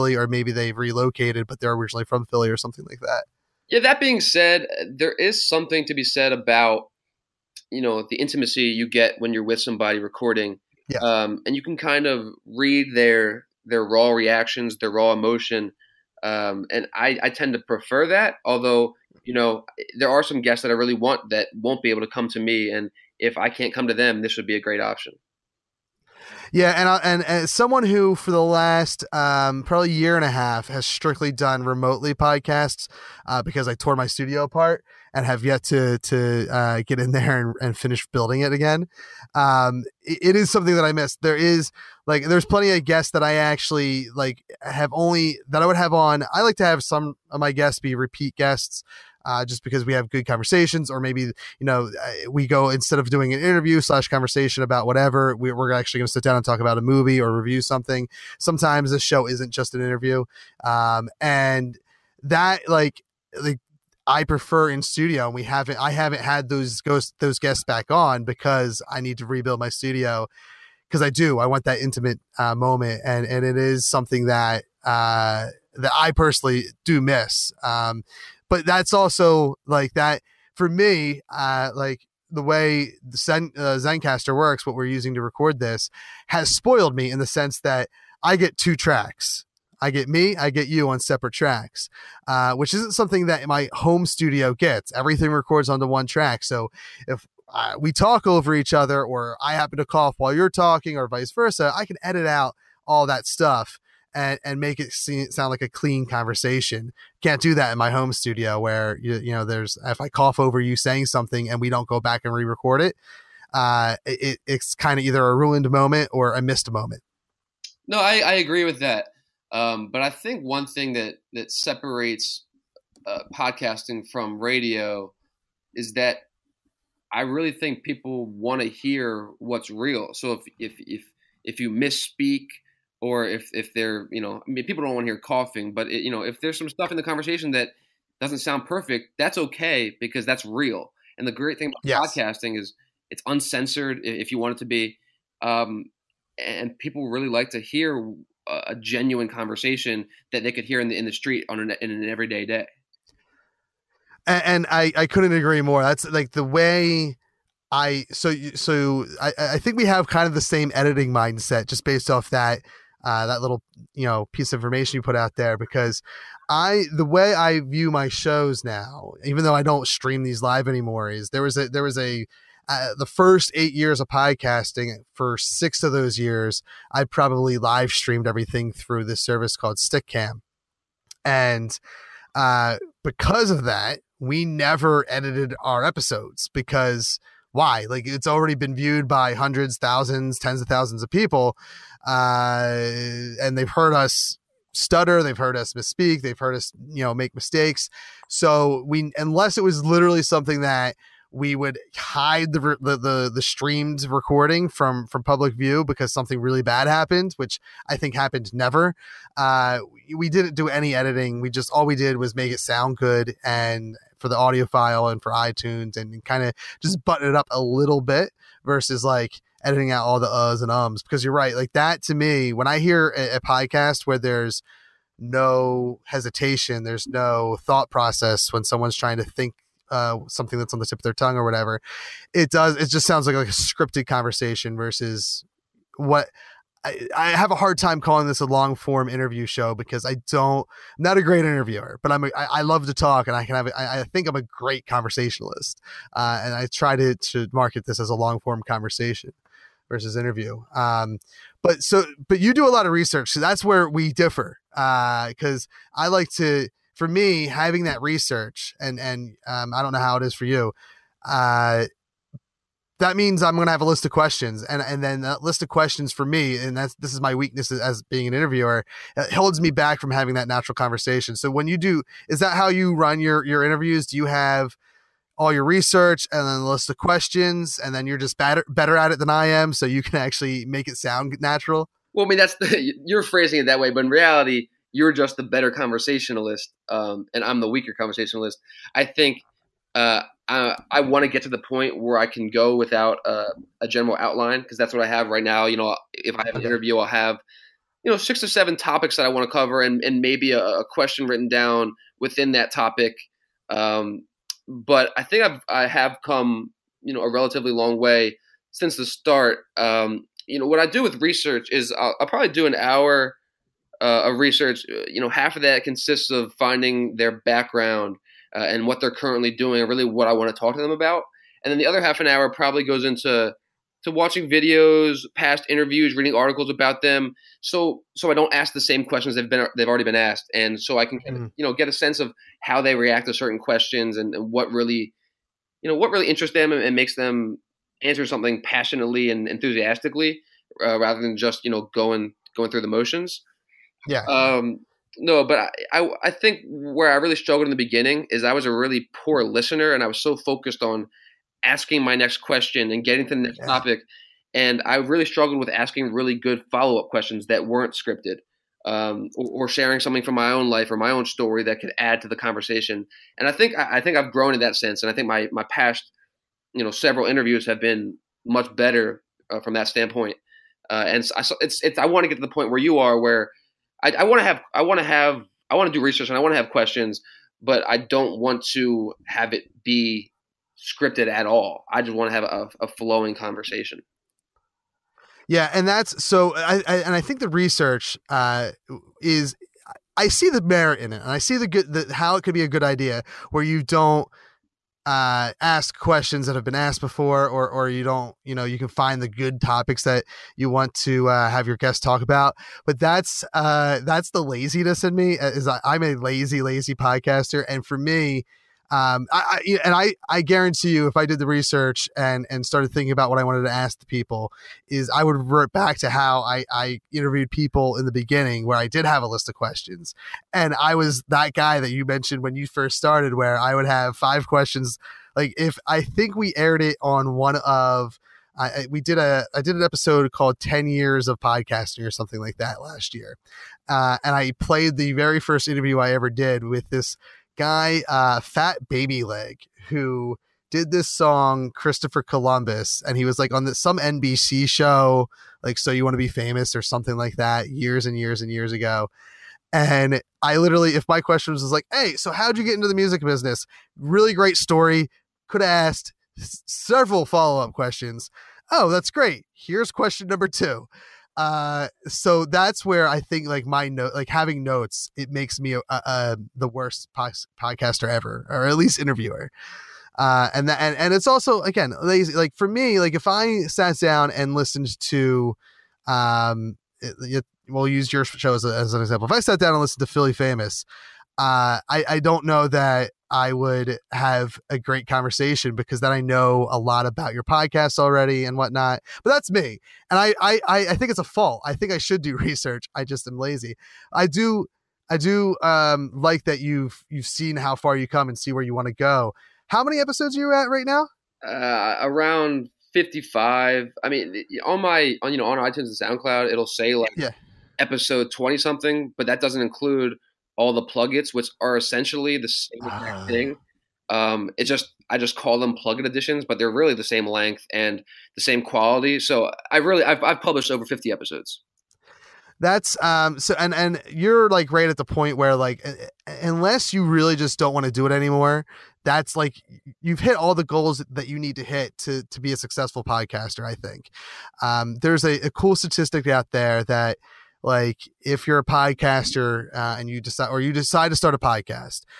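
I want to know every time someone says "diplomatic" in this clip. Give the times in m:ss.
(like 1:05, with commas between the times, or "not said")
not said.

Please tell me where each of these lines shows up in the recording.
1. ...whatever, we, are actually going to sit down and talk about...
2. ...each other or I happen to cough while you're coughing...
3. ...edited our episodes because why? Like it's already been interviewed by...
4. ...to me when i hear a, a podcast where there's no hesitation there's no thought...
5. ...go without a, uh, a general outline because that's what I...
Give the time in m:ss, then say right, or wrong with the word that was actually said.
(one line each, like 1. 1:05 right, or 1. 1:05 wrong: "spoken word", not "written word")
1. 0:54 right
2. 1:38 wrong: "talking", not "coughing"
3. 3:05 wrong: "viewed", not "interviewed"
4. 3:41 right
5. 4:52 right.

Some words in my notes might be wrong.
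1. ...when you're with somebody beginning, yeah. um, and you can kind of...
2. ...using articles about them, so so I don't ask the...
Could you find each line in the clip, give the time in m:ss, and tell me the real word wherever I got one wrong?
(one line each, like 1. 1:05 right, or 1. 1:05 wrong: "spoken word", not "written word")
1. 0:09 wrong: "recording", not "beginning"
2. 5:26 wrong: "reading", not "using".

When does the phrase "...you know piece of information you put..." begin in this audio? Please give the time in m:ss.
2:43.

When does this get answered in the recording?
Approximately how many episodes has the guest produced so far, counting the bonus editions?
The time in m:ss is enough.
8:22.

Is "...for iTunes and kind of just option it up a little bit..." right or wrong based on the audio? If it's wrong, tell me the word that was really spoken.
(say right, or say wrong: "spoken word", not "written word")
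wrong: "button", not "option".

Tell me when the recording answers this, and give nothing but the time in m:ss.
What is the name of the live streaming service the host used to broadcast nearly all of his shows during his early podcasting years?
2:59.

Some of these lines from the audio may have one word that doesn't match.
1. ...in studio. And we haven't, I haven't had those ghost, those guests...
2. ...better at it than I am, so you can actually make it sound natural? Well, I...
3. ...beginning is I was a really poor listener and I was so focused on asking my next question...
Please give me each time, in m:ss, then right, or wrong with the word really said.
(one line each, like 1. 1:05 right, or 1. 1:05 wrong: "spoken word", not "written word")
1. 1:04 right
2. 4:38 right
3. 5:47 right.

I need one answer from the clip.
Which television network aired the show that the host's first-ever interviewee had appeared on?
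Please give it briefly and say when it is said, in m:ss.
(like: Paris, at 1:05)
NBC, at 7:23.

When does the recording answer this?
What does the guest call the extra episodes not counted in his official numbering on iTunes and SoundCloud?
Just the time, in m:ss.
8:35.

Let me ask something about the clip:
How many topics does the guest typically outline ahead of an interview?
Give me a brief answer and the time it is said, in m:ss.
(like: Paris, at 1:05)
6 or 7, at 4:58.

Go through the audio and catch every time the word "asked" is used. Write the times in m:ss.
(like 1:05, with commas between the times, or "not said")
5:30, 6:36, 7:35.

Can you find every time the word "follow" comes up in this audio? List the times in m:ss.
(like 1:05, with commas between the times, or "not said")
5:56, 7:37.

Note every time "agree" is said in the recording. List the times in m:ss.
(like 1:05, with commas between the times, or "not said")
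1:58, 2:35.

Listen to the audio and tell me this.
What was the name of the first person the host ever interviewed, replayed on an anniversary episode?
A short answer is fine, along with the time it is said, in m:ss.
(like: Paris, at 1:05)
Fat Baby Leg, at 7:18.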